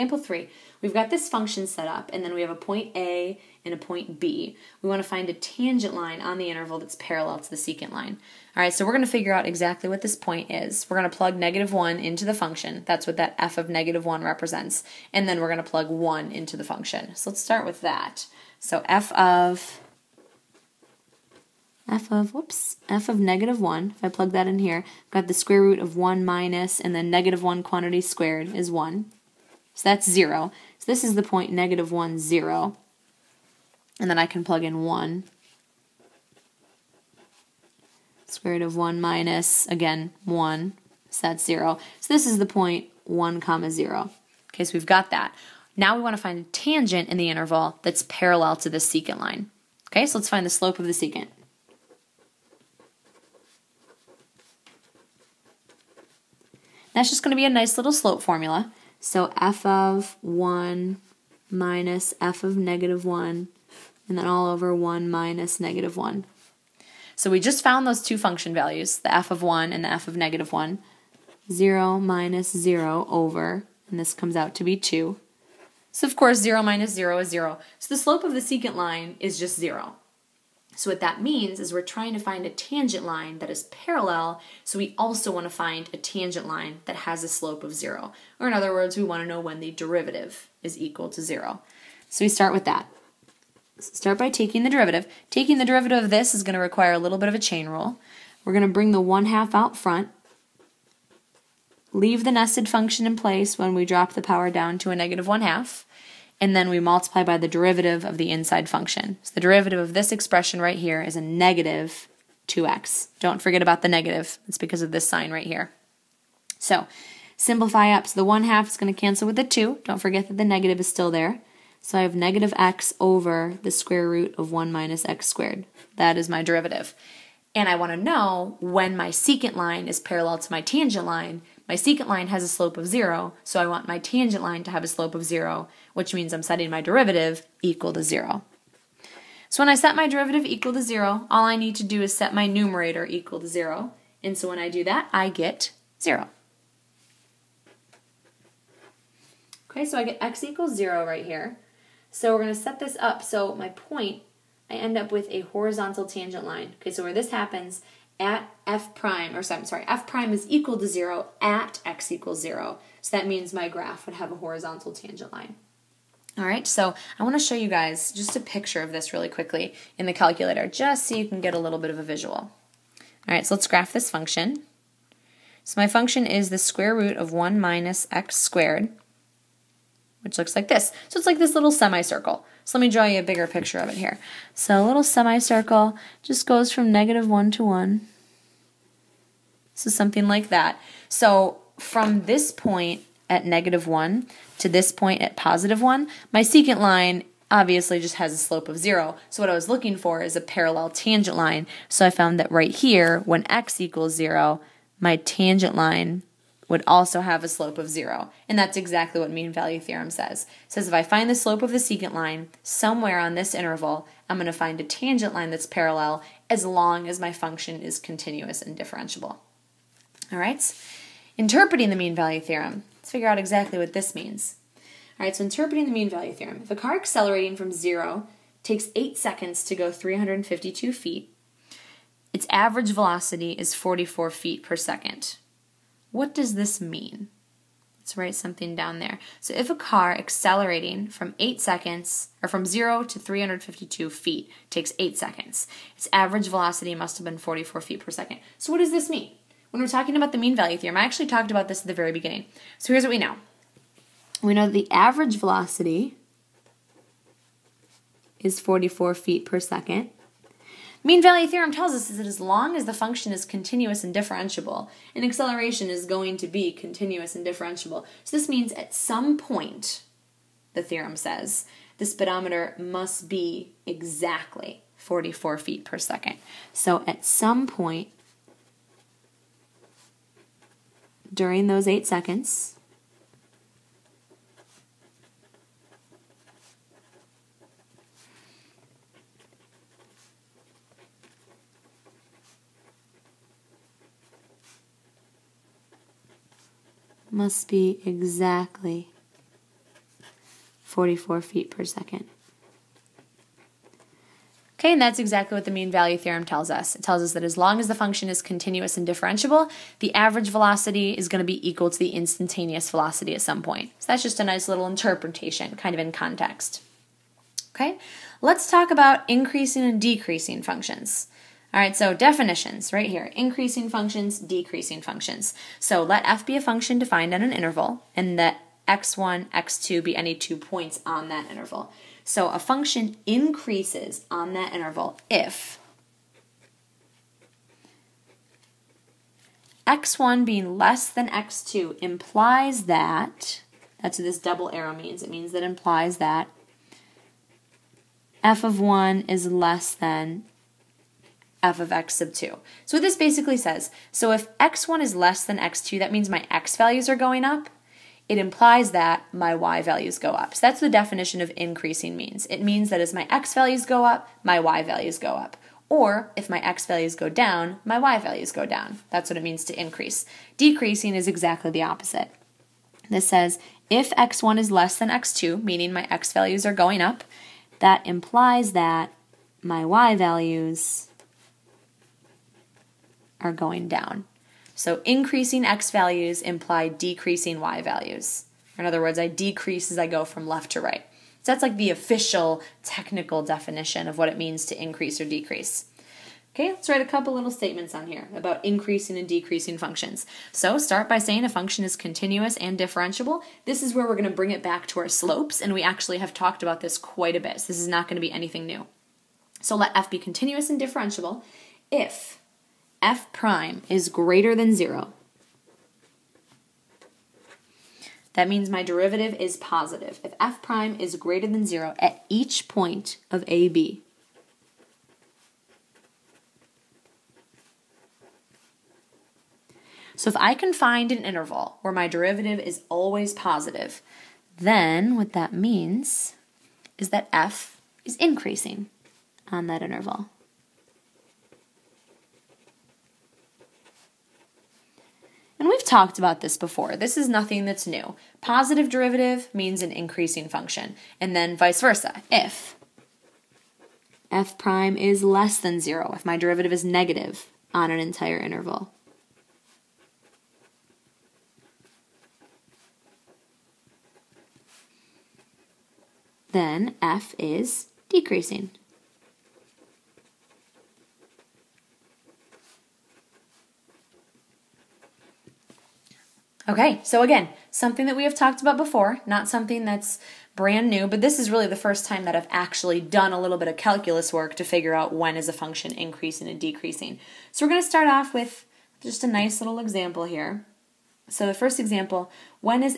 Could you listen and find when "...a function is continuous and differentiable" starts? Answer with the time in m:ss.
6:41.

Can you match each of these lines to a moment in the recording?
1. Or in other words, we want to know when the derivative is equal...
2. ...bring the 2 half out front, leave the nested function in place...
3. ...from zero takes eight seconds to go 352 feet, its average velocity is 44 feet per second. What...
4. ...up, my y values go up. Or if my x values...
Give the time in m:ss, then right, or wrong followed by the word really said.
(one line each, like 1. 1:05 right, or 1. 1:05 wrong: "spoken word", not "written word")
1. 1:28 right
2. 1:38 wrong: "1", not "2"
3. 3:47 right
4. 6:04 right.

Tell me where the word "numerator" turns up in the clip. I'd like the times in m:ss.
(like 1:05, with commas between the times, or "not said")
2:22.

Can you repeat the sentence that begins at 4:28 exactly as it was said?
So this means at some point, the theorem says, the speedometer must be exactly 44 feet per second.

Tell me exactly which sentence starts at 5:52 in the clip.
So what this basically says, so if x1 is less than x2, that means my x values are going up.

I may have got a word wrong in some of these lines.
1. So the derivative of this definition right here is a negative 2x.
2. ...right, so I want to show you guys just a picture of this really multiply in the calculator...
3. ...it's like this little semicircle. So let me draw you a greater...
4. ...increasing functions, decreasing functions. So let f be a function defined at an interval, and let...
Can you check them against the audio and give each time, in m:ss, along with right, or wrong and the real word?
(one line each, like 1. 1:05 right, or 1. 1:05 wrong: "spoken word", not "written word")
1. 1:49 wrong: "expression", not "definition"
2. 2:46 wrong: "quickly", not "multiply"
3. 3:01 wrong: "bigger", not "greater"
4. 5:23 right.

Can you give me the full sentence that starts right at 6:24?
So increasing x values imply decreasing y values.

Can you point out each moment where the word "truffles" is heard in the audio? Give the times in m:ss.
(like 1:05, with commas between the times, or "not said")
not said.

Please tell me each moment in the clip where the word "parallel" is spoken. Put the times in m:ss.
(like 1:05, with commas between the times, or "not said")
0:06, 0:48, 1:23, 2:09, 3:20, 3:35.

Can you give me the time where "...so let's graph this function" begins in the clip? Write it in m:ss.
2:53.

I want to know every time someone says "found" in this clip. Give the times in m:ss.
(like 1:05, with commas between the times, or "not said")
1:07, 3:22.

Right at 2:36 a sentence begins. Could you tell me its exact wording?
Okay, so where this happens at f prime, or I'm sorry, f prime is equal to 0 at x equals 0.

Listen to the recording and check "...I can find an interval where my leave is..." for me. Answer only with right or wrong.
wrong.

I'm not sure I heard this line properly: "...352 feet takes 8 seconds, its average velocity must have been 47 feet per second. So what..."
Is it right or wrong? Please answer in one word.
wrong.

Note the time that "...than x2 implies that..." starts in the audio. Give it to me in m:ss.
5:41.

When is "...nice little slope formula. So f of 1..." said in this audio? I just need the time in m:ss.
0:57.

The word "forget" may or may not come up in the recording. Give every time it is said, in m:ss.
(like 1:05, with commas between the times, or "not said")
1:53, 2:00.